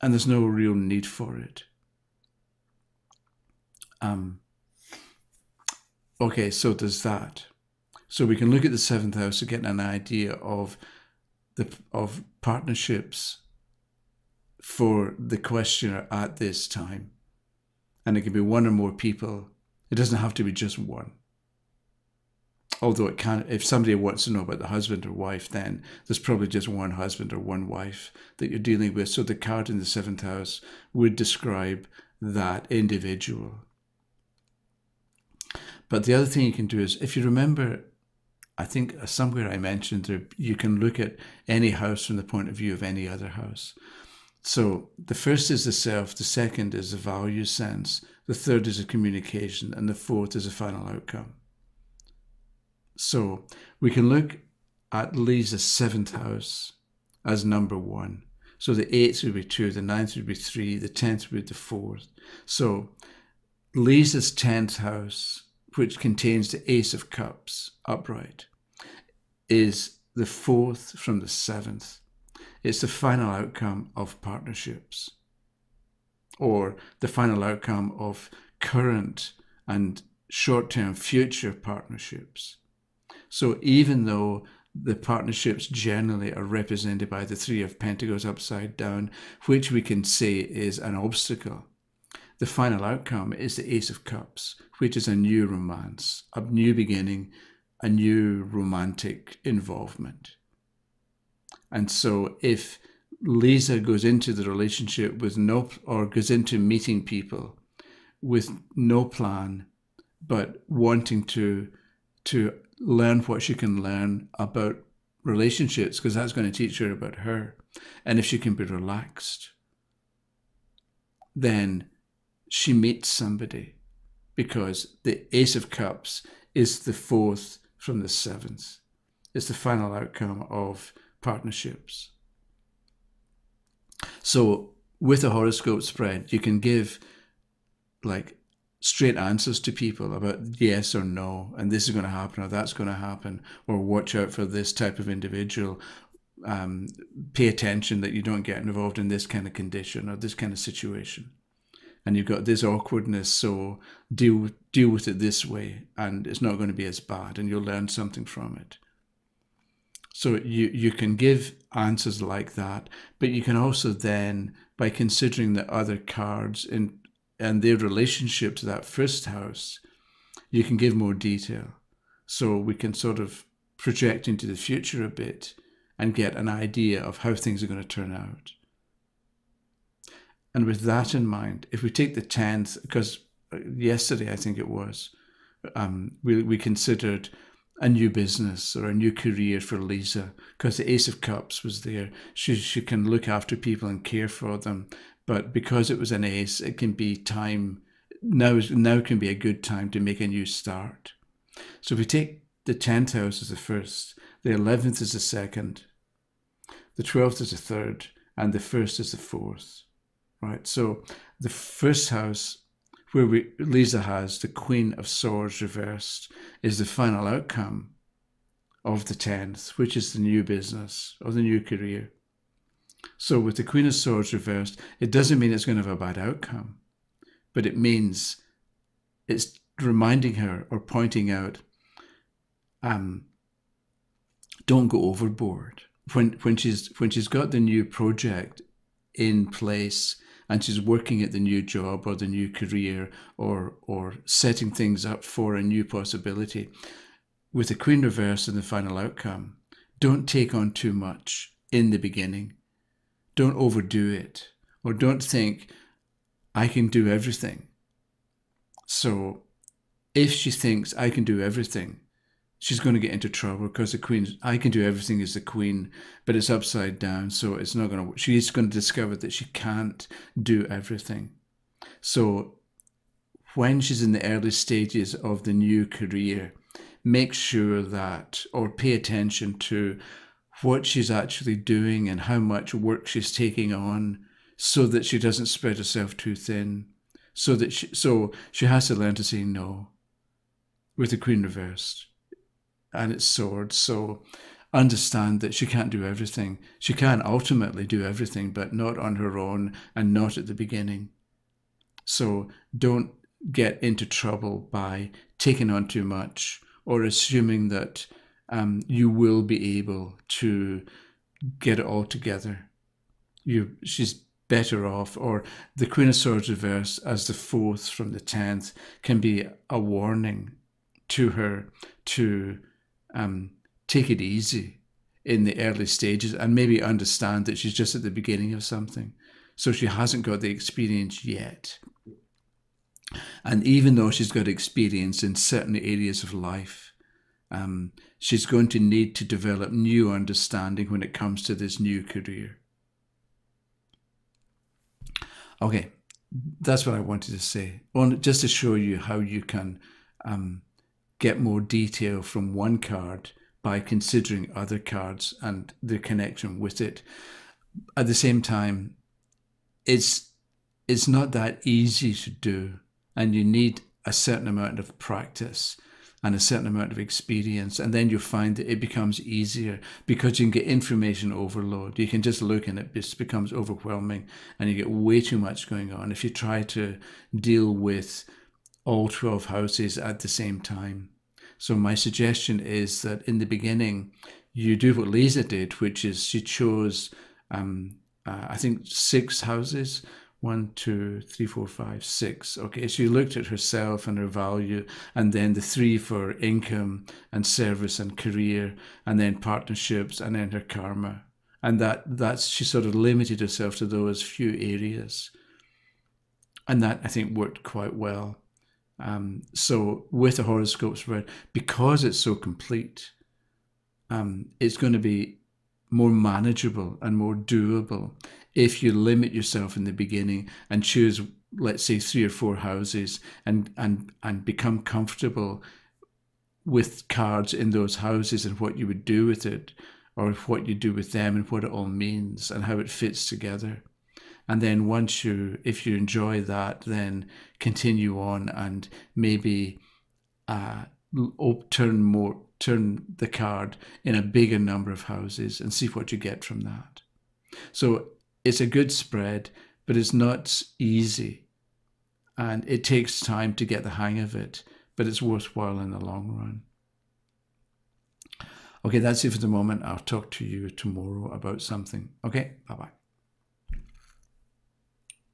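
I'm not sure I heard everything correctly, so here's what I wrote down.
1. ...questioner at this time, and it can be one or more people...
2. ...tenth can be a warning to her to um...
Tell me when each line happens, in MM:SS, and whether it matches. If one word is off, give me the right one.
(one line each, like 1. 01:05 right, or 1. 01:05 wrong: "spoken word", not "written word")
1. 00:15 right
2. 05:18 right.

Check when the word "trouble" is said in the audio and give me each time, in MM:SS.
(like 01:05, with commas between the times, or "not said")
04:23, 05:04.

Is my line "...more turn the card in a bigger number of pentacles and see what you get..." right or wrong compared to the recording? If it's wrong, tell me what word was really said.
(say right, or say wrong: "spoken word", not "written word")
wrong: "houses", not "pentacles".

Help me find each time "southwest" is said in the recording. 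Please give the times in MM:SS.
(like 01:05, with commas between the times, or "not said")
not said.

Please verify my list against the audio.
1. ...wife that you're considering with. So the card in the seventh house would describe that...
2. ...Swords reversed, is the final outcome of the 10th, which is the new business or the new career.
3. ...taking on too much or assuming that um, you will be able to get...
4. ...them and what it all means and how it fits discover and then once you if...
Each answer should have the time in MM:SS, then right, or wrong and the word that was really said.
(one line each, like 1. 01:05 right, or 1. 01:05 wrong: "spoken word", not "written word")
1. 00:27 wrong: "dealing", not "considering"
2. 03:35 right
3. 05:05 right
4. 07:11 wrong: "together", not "discover".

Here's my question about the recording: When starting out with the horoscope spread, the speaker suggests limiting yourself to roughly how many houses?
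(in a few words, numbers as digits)
3 or 4.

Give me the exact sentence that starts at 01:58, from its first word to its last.
And if she can be relaxed, then she meets somebody because the Ace of Cups is the fourth from the seventh.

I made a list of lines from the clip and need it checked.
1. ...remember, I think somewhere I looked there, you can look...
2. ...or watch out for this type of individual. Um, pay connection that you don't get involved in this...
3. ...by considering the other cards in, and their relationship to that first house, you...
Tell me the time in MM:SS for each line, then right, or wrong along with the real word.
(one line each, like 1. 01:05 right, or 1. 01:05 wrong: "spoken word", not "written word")
1. 00:37 wrong: "mentioned", not "looked"
2. 02:23 wrong: "attention", not "connection"
3. 02:44 right.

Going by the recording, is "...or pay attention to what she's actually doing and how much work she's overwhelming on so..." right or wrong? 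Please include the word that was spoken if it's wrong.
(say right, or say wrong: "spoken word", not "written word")
wrong: "taking", not "overwhelming".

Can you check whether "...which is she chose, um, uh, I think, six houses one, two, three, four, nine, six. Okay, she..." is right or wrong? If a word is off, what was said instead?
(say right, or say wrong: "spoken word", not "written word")
wrong: "five", not "nine".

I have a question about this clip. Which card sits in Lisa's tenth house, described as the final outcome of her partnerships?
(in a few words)
Ace of Cups upright.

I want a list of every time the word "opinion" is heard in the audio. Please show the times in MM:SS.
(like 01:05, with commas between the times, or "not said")
not said.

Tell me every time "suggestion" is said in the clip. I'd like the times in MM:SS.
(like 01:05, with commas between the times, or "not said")
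06:21.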